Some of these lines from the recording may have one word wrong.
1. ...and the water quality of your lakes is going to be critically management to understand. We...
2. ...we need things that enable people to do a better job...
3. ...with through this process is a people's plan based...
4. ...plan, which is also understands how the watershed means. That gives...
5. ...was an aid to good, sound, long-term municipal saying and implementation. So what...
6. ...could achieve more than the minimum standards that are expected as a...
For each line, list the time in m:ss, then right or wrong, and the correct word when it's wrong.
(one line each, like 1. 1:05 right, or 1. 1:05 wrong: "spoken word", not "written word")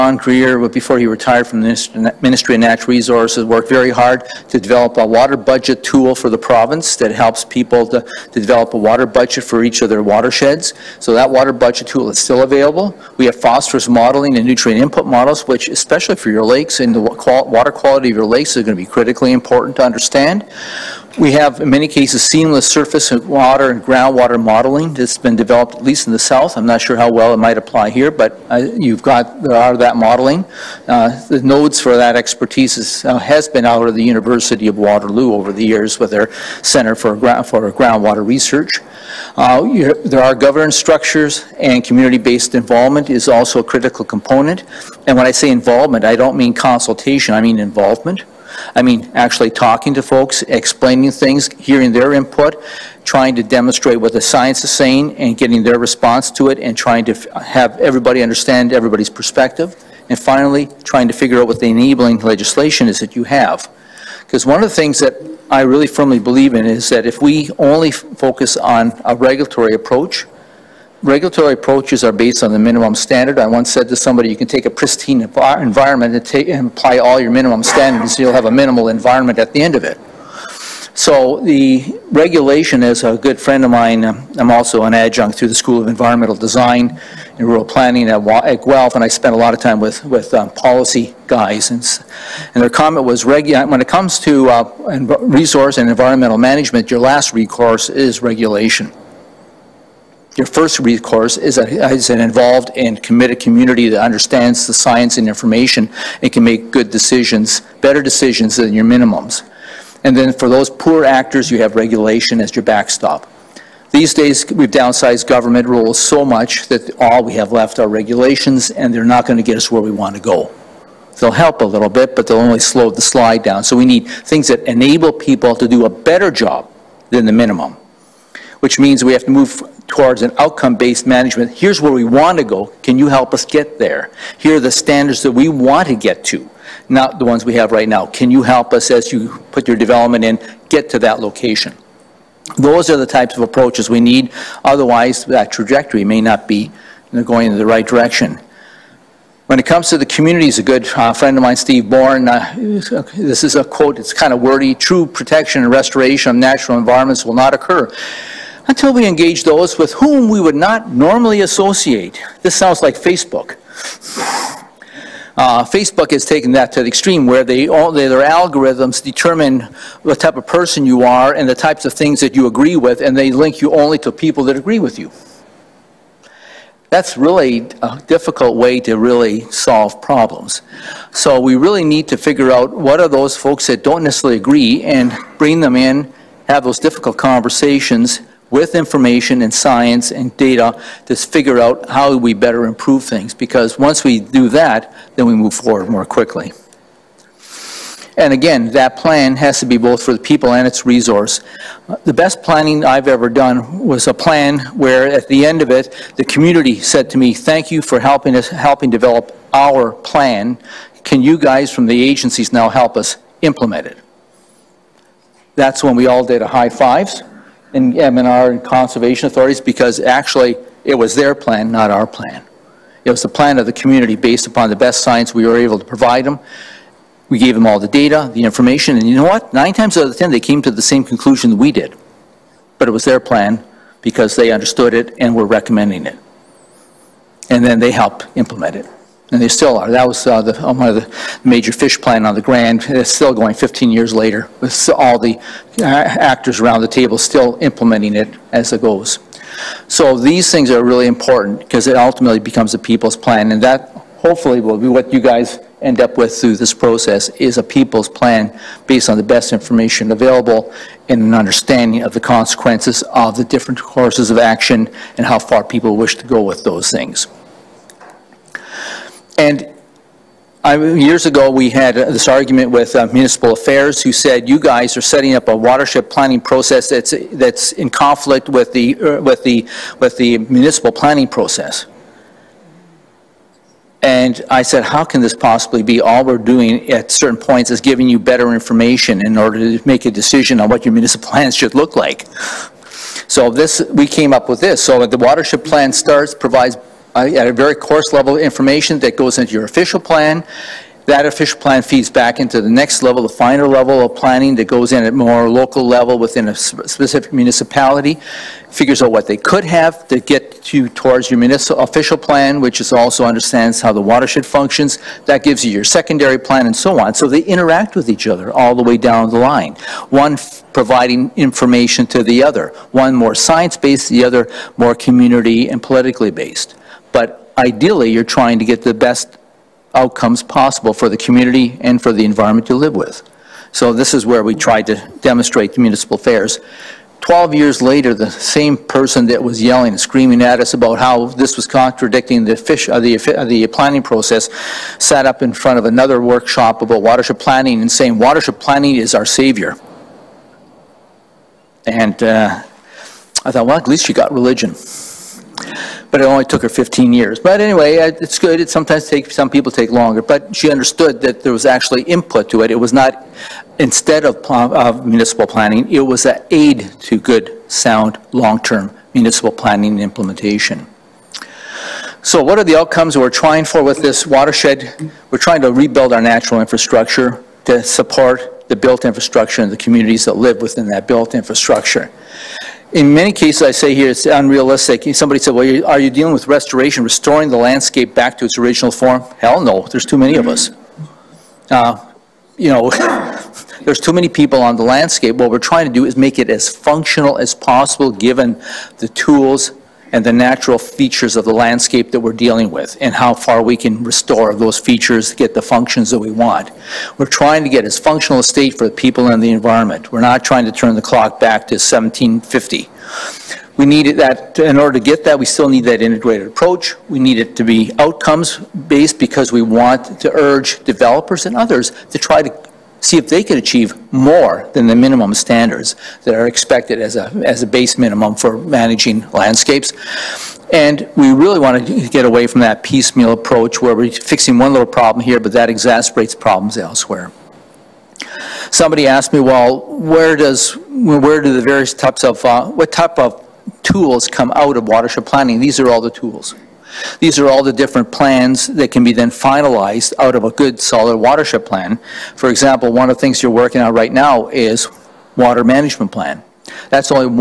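1. 0:16 wrong: "important", not "management"
2. 2:03 right
3. 4:16 right
4. 5:12 wrong: "functions", not "means"
5. 6:06 wrong: "planning", not "saying"
6. 7:03 right.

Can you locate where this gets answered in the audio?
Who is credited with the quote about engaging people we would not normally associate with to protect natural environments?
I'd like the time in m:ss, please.
2:31.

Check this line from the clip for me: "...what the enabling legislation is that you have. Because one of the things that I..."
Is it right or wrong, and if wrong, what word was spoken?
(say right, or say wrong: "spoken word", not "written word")
right.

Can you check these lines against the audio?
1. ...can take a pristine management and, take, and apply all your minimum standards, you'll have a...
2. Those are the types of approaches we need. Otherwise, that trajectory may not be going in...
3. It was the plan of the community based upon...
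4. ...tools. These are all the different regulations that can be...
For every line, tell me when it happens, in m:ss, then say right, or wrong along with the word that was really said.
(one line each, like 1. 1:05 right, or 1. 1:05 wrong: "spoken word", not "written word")
1. 1:14 wrong: "environment", not "management"
2. 2:22 right
3. 3:43 right
4. 7:26 wrong: "plans", not "regulations".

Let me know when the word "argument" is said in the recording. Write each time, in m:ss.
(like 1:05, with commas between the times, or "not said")
4:32.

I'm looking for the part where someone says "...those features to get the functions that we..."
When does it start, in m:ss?
6:44.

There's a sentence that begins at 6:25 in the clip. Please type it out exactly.
Somebody said, well, are you dealing with restoration, restoring the landscape back to its original form?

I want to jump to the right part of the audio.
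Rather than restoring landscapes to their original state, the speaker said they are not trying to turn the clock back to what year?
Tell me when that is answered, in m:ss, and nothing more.
6:51.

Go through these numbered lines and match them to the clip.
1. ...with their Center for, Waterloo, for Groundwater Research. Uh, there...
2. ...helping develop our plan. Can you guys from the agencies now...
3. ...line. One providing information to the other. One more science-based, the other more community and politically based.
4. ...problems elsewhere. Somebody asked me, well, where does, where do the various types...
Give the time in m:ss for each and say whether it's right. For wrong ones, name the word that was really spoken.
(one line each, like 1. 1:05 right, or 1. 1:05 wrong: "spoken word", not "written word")
1. 0:35 wrong: "Ground", not "Waterloo"
2. 3:28 right
3. 5:19 right
4. 7:16 right.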